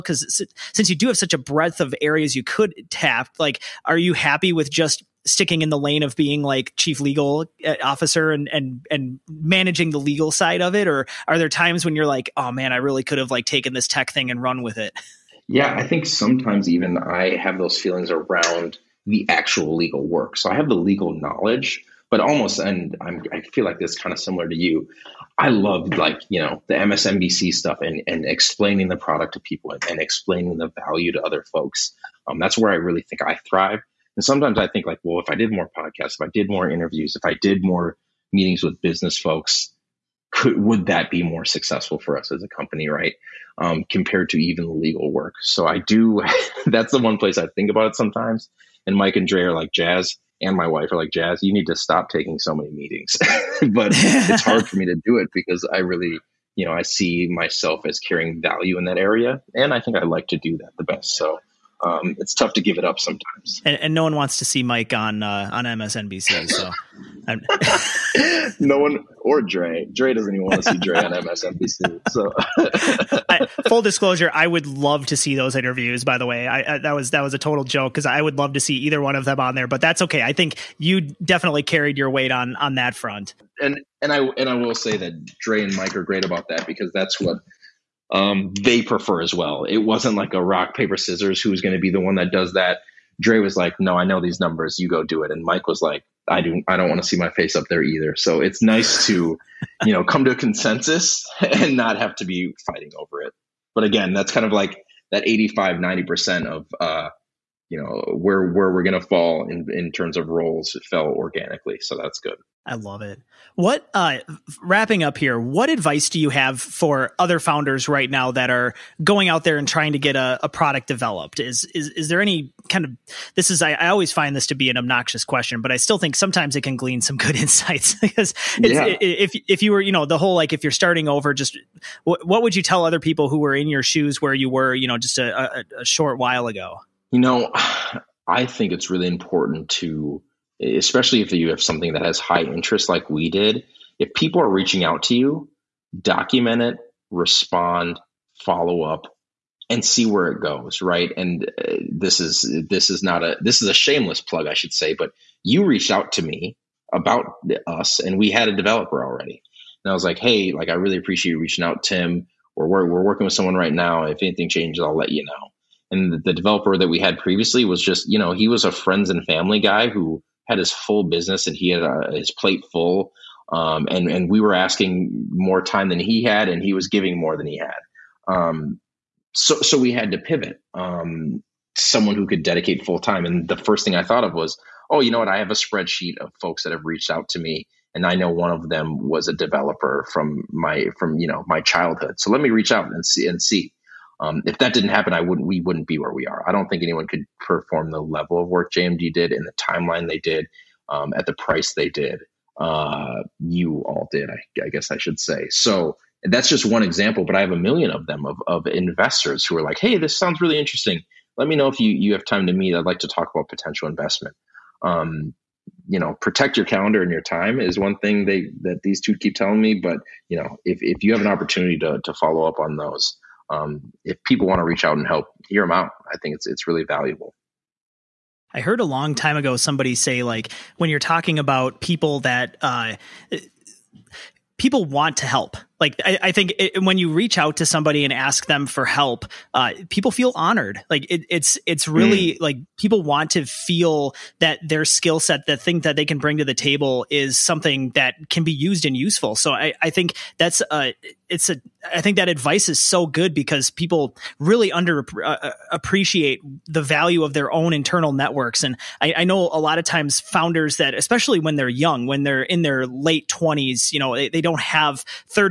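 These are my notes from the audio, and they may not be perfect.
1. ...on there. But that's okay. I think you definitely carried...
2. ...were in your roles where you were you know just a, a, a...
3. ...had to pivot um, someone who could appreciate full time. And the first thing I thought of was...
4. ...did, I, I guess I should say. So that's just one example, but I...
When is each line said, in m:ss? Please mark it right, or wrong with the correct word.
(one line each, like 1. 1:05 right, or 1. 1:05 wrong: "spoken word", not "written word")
1. 1:19 right
2. 2:13 wrong: "shoes", not "roles"
3. 2:59 wrong: "dedicate", not "appreciate"
4. 3:24 right.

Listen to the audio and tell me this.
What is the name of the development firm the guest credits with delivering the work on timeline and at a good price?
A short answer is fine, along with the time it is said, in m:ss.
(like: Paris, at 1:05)
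JMG, at 3:18.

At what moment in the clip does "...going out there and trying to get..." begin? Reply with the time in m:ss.
1:59.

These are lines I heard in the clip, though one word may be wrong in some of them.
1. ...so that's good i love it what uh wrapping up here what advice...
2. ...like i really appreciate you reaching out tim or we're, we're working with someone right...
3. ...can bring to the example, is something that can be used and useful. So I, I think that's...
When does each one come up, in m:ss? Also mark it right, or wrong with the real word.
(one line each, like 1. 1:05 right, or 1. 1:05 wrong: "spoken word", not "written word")
1. 1:51 right
2. 2:40 right
3. 4:06 wrong: "table", not "example".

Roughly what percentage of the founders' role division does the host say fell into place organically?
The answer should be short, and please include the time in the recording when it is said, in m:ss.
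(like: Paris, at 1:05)
85-90%, at 1:45.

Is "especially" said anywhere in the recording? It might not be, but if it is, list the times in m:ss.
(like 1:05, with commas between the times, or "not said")
2:20, 4:20.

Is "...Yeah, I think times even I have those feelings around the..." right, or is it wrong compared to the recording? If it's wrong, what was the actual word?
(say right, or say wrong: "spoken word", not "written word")
wrong: "sometimes", not "times".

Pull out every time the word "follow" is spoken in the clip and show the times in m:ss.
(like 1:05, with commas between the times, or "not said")
2:28, 3:42.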